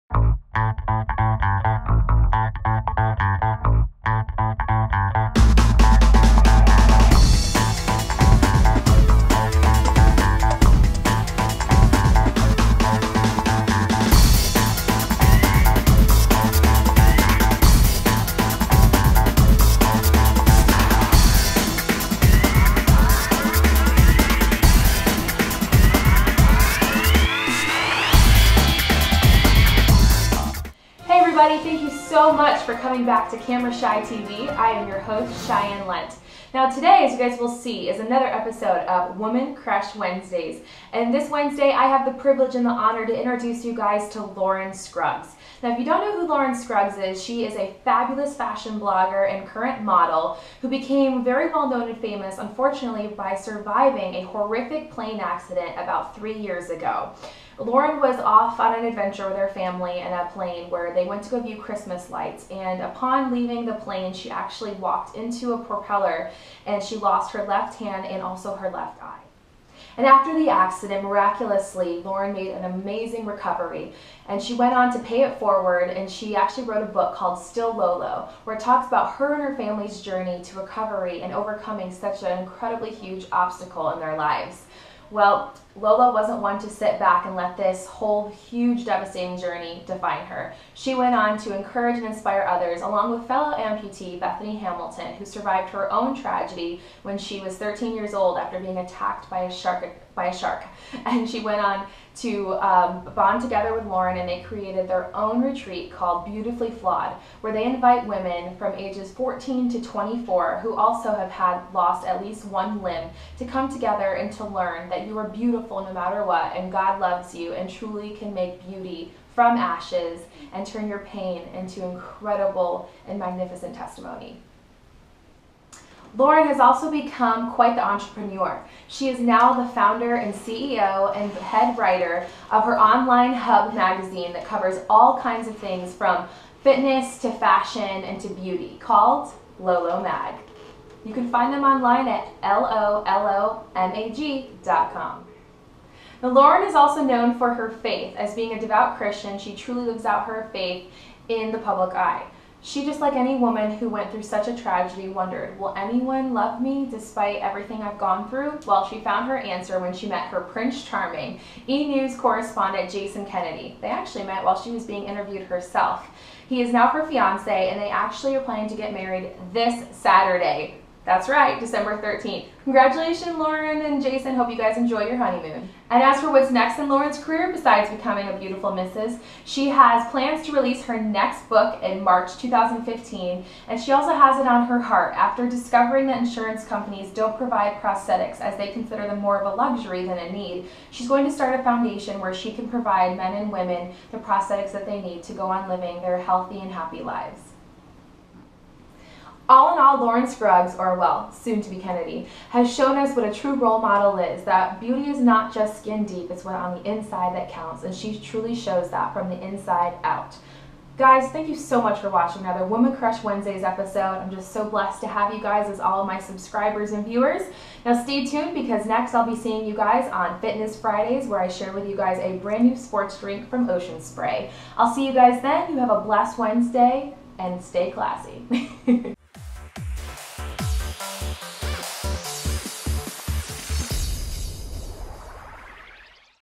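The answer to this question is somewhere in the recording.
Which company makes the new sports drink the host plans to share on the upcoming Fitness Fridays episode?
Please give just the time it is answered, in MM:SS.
03:43.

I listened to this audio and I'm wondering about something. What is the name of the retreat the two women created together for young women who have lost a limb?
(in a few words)
Beautifully Flawed.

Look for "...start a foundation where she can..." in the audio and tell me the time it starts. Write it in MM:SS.
03:11.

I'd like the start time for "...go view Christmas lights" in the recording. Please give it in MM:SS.
01:01.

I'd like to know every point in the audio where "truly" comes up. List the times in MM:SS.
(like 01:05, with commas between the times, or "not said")
01:57, 02:29, 03:28.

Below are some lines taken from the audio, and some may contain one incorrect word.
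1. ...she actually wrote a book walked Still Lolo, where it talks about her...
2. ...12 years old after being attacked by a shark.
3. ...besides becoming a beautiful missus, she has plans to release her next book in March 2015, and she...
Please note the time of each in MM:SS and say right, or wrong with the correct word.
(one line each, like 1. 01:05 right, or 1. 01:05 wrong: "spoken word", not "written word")
1. 01:16 wrong: "called", not "walked"
2. 01:37 wrong: "13", not "12"
3. 02:57 right.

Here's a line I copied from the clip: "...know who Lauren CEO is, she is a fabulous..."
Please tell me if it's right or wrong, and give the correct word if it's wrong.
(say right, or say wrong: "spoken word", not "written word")
wrong: "Scruggs", not "CEO".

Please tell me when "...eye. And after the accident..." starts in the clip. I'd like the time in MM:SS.
01:09.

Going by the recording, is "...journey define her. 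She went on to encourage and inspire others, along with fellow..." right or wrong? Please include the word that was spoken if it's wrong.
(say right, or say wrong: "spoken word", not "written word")
right.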